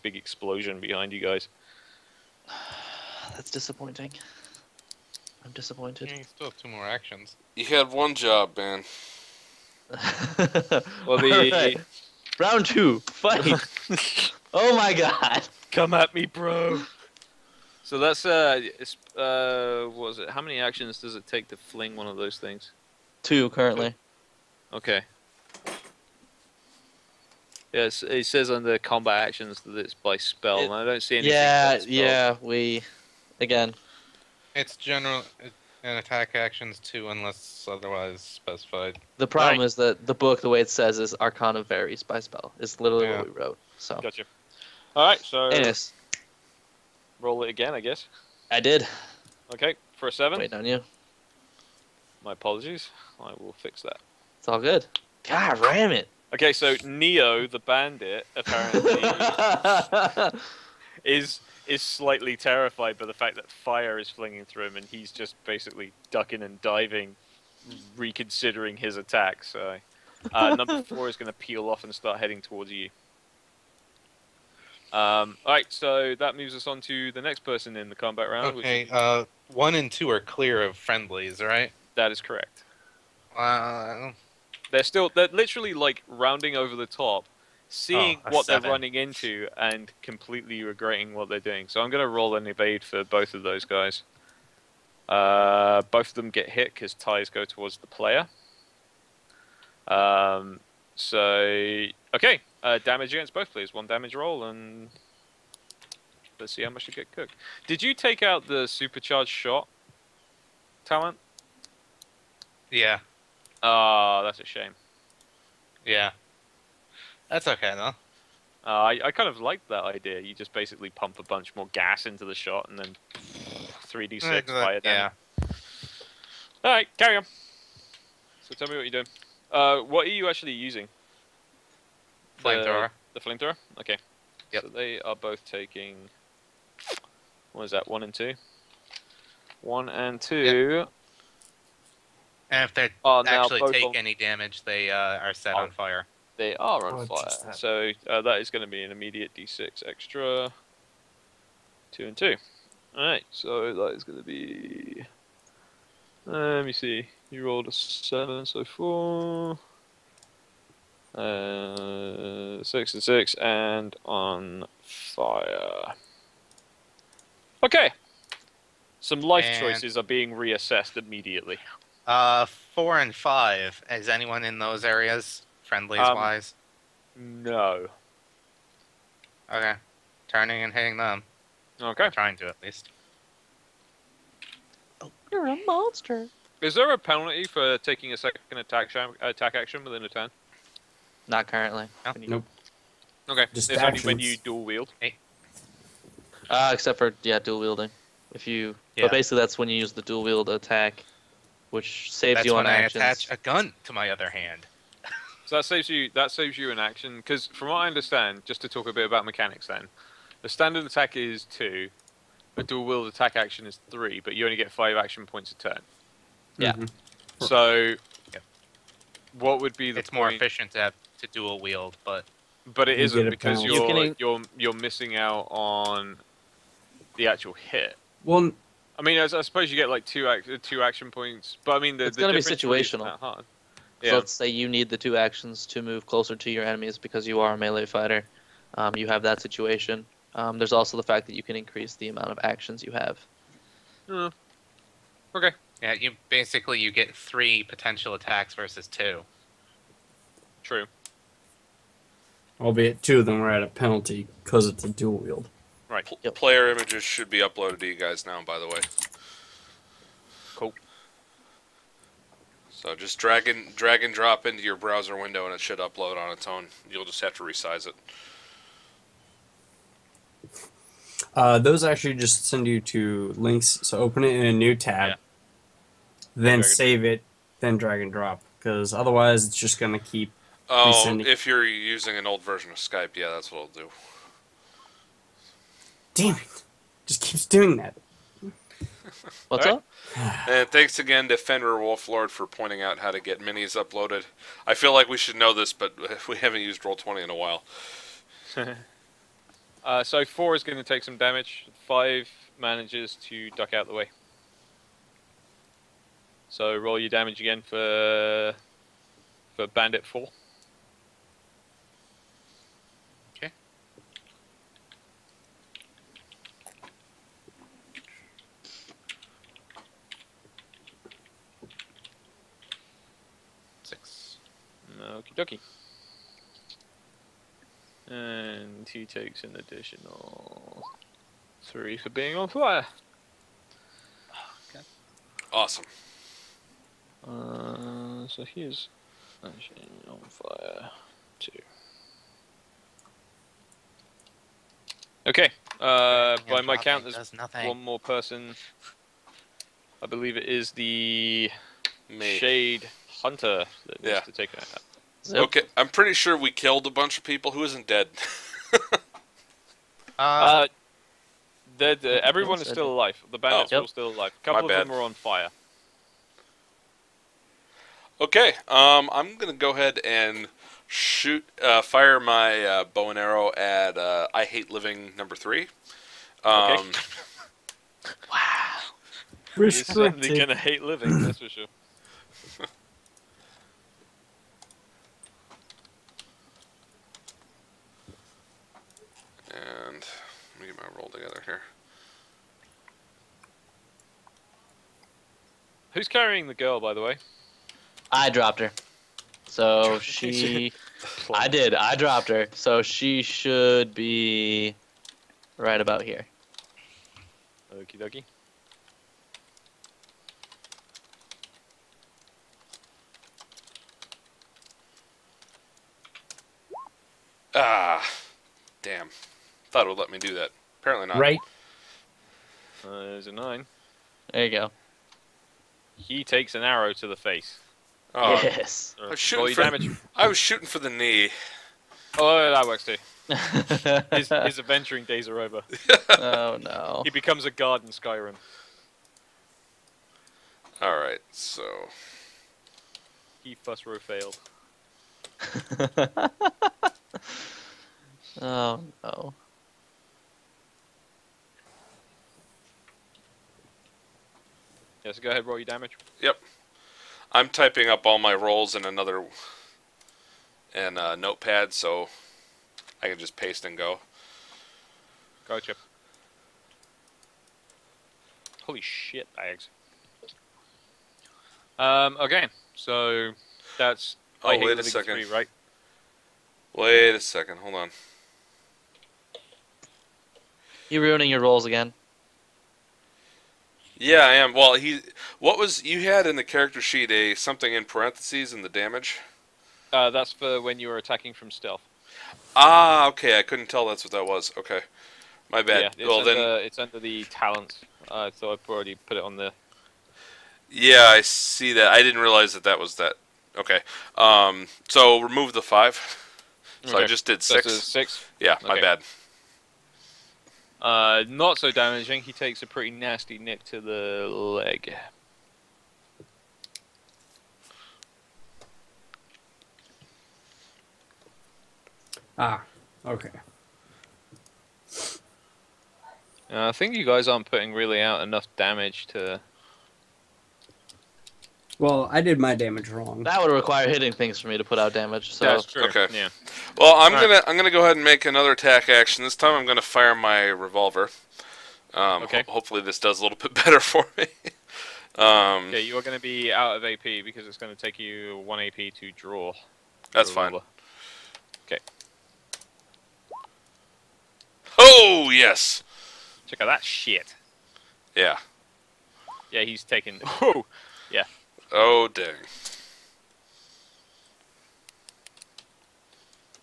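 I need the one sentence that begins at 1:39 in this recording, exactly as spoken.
Um, so okay, uh, damage against both, please.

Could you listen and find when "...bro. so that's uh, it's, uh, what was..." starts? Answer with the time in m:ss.
0:16.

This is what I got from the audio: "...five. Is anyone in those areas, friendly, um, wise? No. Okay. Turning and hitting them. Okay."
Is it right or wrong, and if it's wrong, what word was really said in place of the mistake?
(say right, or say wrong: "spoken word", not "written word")
right.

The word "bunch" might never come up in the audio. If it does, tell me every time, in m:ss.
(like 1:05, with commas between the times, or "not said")
2:01, 5:56.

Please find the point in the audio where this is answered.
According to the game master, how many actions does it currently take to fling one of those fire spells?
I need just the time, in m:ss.
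0:23.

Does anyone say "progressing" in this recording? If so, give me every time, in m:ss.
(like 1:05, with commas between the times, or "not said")
not said.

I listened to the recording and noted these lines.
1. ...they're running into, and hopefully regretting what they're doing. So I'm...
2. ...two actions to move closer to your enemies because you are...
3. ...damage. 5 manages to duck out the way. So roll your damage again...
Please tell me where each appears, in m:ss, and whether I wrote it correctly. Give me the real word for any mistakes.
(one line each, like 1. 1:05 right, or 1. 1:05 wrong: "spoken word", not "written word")
1. 1:28 wrong: "completely", not "hopefully"
2. 3:54 right
3. 5:01 right.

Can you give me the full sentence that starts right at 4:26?
You'll just have to resize it.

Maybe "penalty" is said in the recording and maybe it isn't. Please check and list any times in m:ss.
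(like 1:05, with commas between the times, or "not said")
3:06, 4:13.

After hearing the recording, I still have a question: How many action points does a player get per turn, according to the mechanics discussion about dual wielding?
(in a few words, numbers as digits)
5.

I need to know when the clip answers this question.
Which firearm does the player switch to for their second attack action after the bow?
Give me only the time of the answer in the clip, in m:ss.
9:00.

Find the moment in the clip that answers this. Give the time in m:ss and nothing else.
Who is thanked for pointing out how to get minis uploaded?
4:51.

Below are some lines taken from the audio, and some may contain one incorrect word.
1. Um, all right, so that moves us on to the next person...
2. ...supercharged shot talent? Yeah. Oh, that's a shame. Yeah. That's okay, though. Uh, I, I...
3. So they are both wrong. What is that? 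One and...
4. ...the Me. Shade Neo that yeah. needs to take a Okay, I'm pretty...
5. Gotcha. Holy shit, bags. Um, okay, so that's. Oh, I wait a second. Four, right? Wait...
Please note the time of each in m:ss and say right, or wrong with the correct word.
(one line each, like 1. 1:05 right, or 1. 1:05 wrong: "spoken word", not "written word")
1. 1:14 right
2. 1:48 right
3. 2:14 wrong: "taking", not "wrong"
4. 5:50 wrong: "Hunter", not "Neo"
5. 7:45 wrong: "Three", not "Four".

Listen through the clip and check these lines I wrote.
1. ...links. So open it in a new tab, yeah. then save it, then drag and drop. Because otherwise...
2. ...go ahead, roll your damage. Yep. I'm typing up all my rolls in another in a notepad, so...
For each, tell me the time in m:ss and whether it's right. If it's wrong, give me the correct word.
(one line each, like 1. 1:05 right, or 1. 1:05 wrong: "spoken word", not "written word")
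1. 4:33 right
2. 7:35 right.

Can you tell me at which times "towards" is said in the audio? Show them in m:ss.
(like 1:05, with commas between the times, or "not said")
1:12, 1:37.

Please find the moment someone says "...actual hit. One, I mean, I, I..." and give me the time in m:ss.
3:47.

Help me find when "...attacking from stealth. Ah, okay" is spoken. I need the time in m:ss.
8:10.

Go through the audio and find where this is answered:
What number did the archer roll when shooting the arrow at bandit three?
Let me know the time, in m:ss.
7:03.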